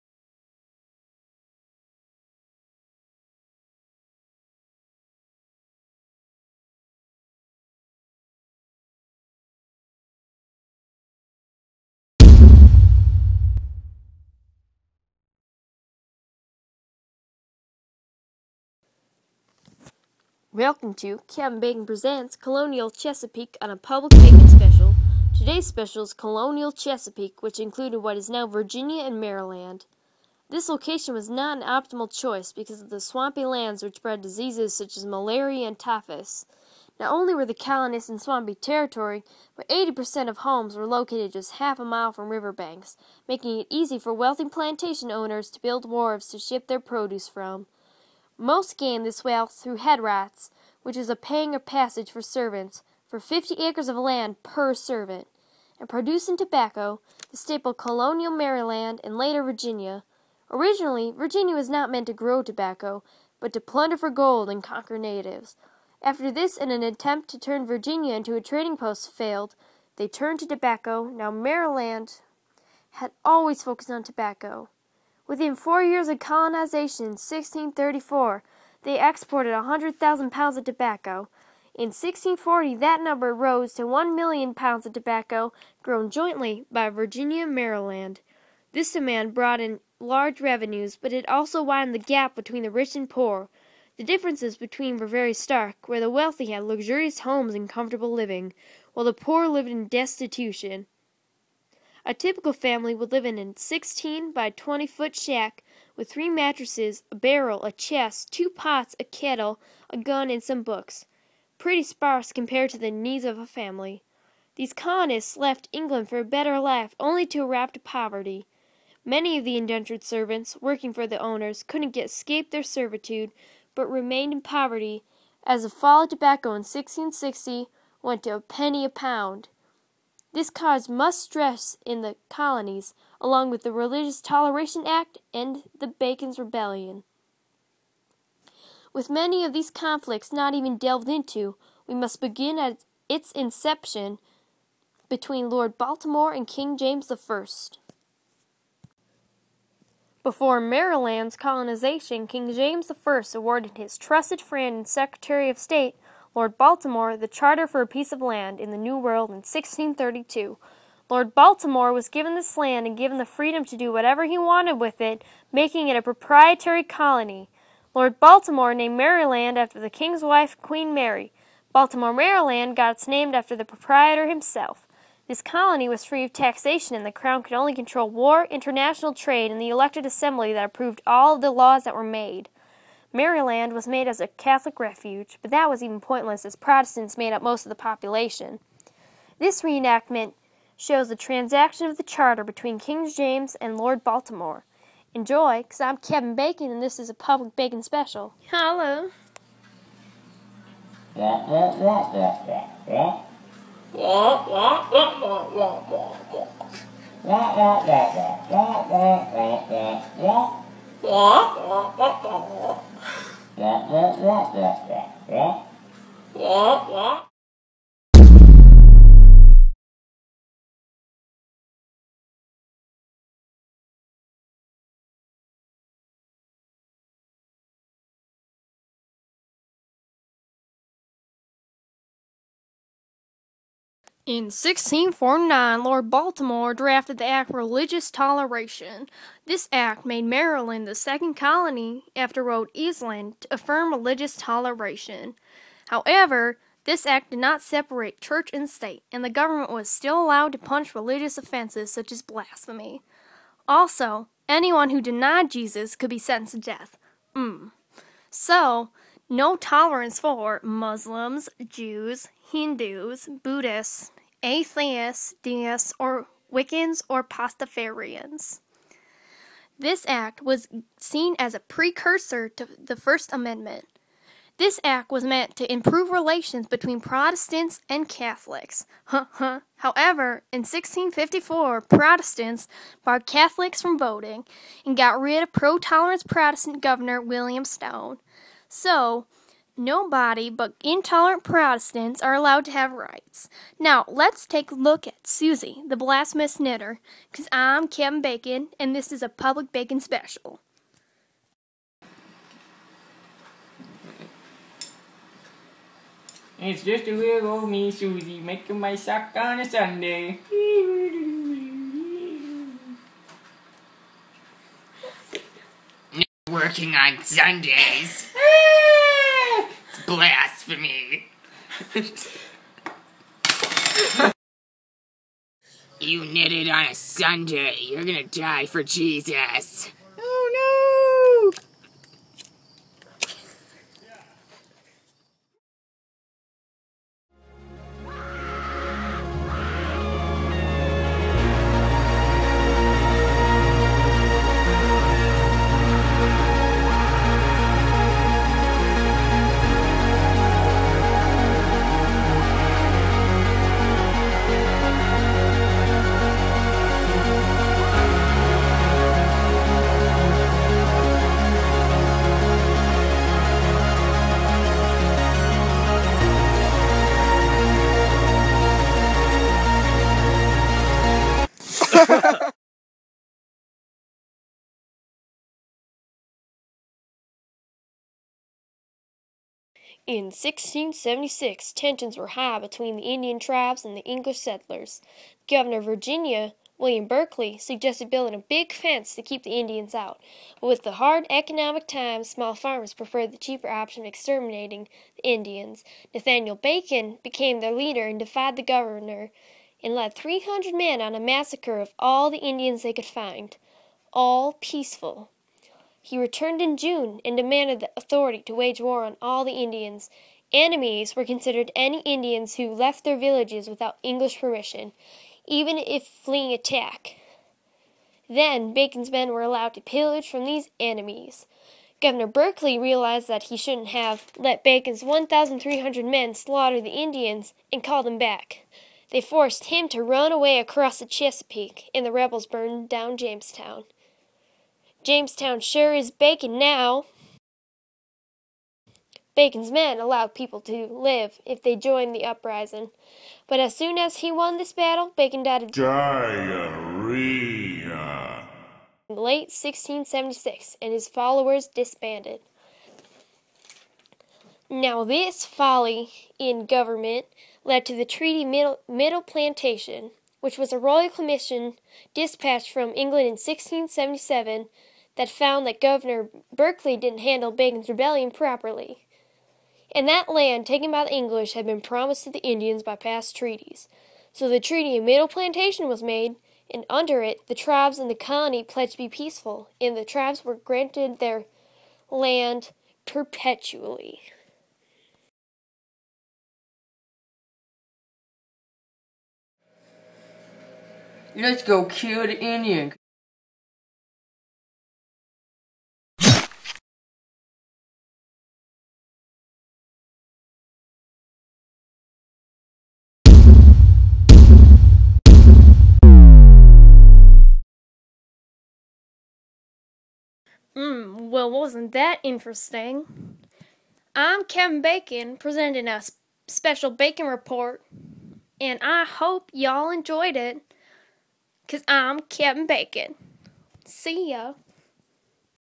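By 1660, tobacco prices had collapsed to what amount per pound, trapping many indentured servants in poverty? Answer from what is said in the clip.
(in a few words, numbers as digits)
a penny.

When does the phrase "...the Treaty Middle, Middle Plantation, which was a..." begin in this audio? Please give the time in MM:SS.
07:37.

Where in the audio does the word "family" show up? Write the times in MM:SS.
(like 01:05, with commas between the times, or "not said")
01:42, 01:53.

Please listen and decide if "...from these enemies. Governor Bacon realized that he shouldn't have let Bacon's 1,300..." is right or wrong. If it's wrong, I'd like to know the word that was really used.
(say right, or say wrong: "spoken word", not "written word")
wrong: "Berkeley", not "Bacon".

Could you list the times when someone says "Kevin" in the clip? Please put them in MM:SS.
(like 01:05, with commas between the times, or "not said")
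00:21, 03:15, 08:34, 08:42.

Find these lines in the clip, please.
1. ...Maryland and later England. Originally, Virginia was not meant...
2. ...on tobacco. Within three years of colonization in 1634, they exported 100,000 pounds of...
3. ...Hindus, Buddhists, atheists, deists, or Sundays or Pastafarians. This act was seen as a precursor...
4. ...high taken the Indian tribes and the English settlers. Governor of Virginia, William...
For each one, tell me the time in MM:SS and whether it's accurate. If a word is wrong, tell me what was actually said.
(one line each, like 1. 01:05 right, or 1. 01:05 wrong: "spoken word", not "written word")
1. 00:58 wrong: "Virginia", not "England"
2. 01:13 wrong: "four", not "three"
3. 04:22 wrong: "Wiccans", not "Sundays"
4. 06:22 wrong: "between", not "taken".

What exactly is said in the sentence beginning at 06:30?
But with the hard economic times, small farmers preferred the cheaper option of exterminating the Indians.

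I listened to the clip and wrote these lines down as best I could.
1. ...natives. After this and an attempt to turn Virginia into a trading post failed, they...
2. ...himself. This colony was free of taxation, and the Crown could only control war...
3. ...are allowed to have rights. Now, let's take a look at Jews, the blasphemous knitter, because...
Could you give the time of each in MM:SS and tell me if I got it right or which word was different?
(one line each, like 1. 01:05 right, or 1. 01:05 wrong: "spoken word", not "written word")
1. 01:04 right
2. 02:54 right
3. 04:52 wrong: "Susie", not "Jews".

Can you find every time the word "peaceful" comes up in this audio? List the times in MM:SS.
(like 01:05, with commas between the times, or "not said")
06:44, 07:59.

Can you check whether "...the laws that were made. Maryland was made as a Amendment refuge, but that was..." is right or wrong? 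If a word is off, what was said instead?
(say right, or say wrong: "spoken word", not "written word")
wrong: "Catholic", not "Amendment".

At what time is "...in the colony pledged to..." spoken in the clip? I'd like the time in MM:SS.
07:57.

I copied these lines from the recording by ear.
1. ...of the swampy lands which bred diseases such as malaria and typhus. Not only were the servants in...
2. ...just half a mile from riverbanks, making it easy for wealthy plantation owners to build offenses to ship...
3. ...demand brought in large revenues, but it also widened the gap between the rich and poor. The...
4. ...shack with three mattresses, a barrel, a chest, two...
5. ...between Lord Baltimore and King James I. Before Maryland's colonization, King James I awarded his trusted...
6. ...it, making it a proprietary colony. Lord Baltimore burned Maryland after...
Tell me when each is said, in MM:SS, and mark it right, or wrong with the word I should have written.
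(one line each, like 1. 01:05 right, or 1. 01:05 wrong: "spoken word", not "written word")
1. 00:32 wrong: "colonists", not "servants"
2. 00:41 wrong: "wharves", not "offenses"
3. 01:28 right
4. 01:45 right
5. 02:25 right
6. 02:45 wrong: "named", not "burned".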